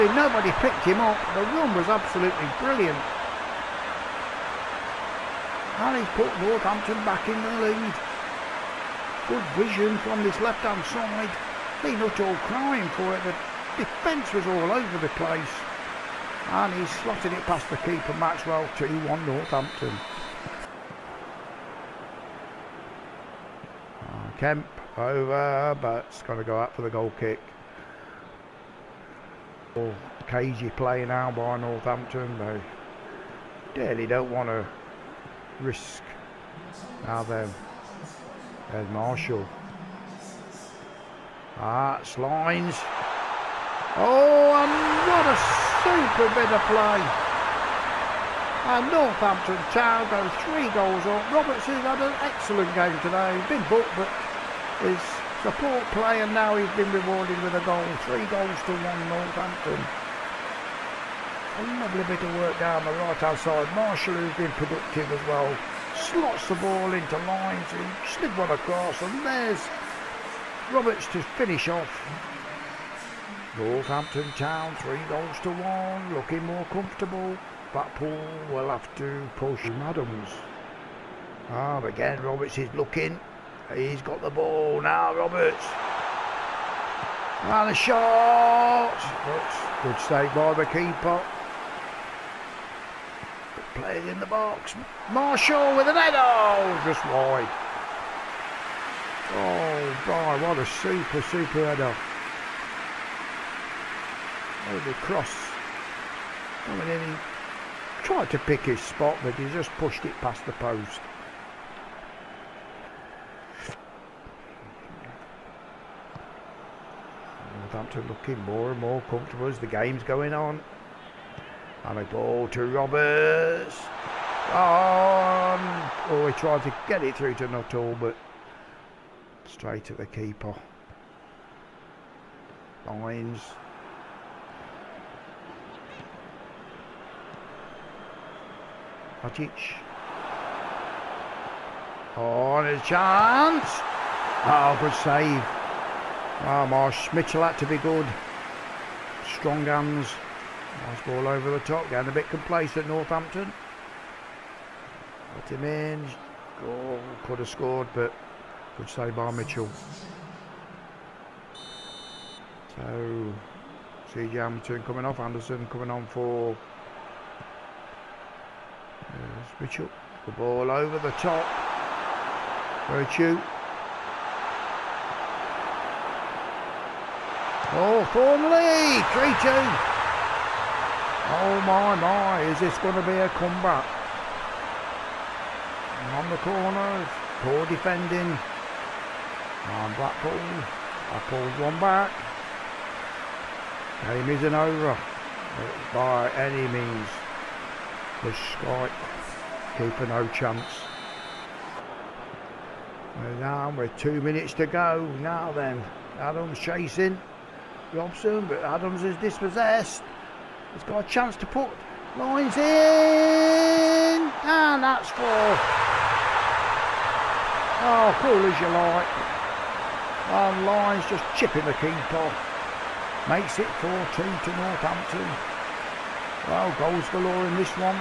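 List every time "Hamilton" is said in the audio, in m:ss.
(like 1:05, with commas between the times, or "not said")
2:44.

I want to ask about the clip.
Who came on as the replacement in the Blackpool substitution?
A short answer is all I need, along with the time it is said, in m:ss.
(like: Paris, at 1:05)
Anderson, at 2:45.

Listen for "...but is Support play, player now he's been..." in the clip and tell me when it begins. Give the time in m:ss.
0:53.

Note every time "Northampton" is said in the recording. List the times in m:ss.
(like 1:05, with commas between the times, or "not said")
0:06, 0:19, 0:31, 0:48, 0:59, 1:13, 2:32, 3:44.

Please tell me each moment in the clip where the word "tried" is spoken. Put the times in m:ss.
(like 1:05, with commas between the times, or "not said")
1:48, 2:06.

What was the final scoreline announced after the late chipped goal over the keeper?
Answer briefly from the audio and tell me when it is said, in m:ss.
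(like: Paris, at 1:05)
4-2, at 3:43.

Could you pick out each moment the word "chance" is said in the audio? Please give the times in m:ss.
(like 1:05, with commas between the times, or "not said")
2:22, 3:20, 3:31.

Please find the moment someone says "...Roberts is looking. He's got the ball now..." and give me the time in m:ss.
1:22.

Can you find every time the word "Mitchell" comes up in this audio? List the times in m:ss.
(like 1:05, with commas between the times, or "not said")
2:27, 2:39, 2:49.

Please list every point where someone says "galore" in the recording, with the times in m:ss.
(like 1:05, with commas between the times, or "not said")
3:47.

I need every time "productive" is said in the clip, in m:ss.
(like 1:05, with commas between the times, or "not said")
1:04.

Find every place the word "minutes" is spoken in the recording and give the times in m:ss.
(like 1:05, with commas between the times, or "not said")
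3:24.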